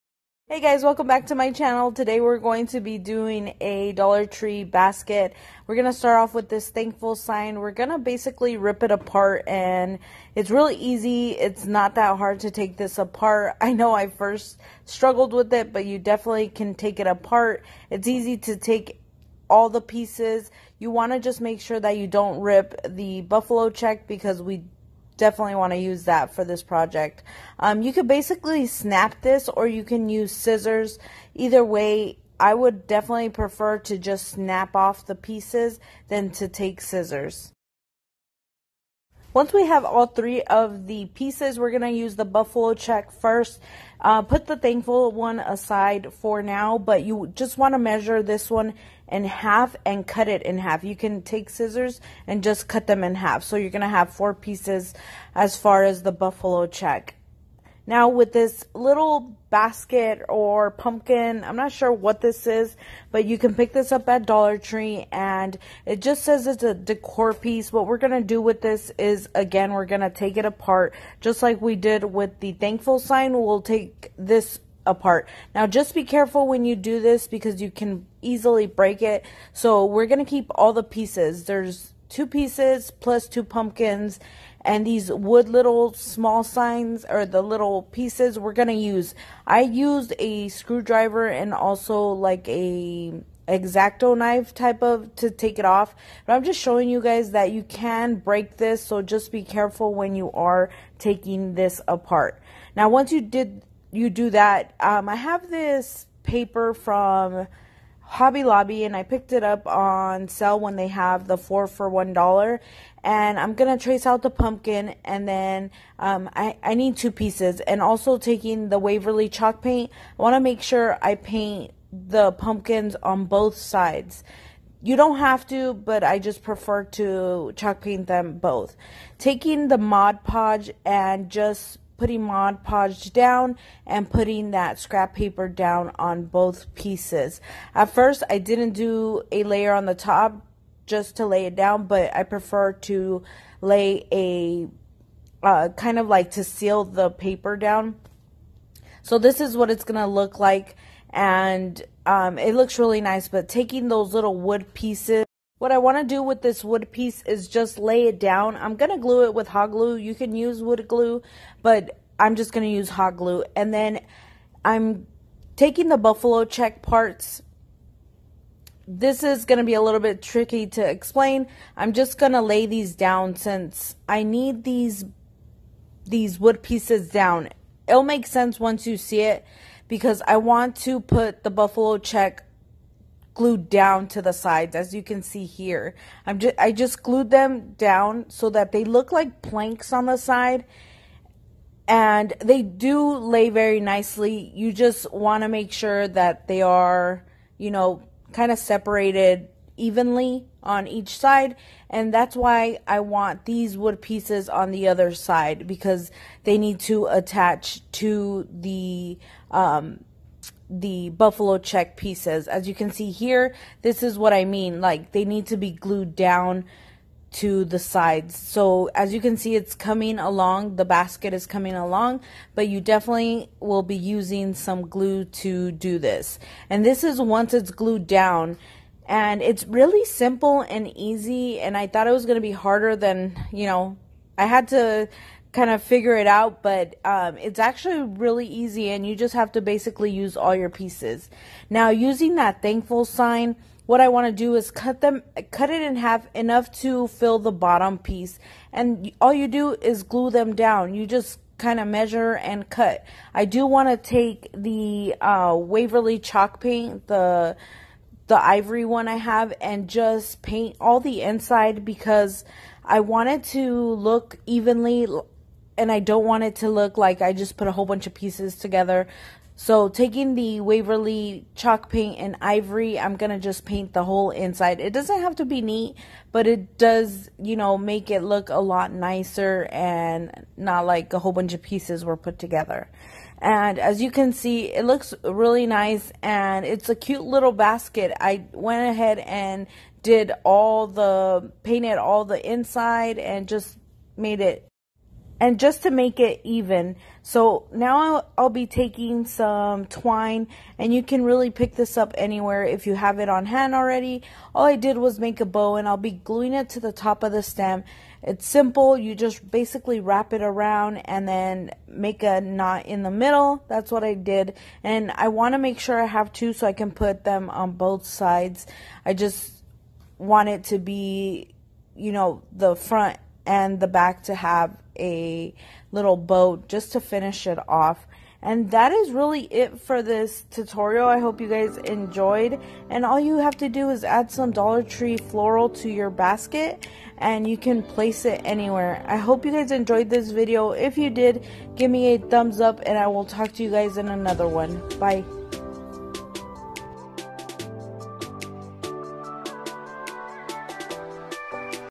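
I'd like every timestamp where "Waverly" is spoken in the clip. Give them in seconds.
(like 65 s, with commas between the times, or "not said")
118 s, 255 s, 270 s.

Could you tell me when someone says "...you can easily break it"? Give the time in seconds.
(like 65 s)
77 s.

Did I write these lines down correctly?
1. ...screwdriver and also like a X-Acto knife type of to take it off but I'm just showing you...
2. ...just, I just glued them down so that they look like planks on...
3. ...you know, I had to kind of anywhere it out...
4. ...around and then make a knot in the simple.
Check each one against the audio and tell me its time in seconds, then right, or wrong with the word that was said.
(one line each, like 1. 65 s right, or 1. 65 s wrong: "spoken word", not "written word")
1. 90 s right
2. 186 s right
3. 233 s wrong: "figure", not "anywhere"
4. 310 s wrong: "middle", not "simple".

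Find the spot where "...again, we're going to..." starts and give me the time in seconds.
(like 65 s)
69 s.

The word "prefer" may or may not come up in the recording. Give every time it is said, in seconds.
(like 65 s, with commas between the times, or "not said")
33 s, 126 s, 142 s.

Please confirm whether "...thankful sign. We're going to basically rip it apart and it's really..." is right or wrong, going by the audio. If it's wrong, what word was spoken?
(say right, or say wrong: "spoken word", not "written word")
right.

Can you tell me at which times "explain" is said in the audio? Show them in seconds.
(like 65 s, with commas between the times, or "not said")
170 s.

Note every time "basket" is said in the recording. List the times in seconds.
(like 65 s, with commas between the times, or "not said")
4 s, 59 s, 220 s, 287 s, 336 s.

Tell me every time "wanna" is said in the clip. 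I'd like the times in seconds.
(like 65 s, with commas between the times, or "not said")
120 s.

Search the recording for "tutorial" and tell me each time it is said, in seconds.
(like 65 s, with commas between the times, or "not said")
330 s.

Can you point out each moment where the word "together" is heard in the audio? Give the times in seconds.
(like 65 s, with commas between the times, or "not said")
268 s, 282 s.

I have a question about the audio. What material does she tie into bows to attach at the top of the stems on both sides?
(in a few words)
twine.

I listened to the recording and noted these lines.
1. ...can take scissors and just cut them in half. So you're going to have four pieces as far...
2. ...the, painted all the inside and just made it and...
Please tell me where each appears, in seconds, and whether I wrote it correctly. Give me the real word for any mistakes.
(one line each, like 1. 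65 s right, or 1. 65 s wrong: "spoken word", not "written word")
1. 50 s right
2. 290 s right.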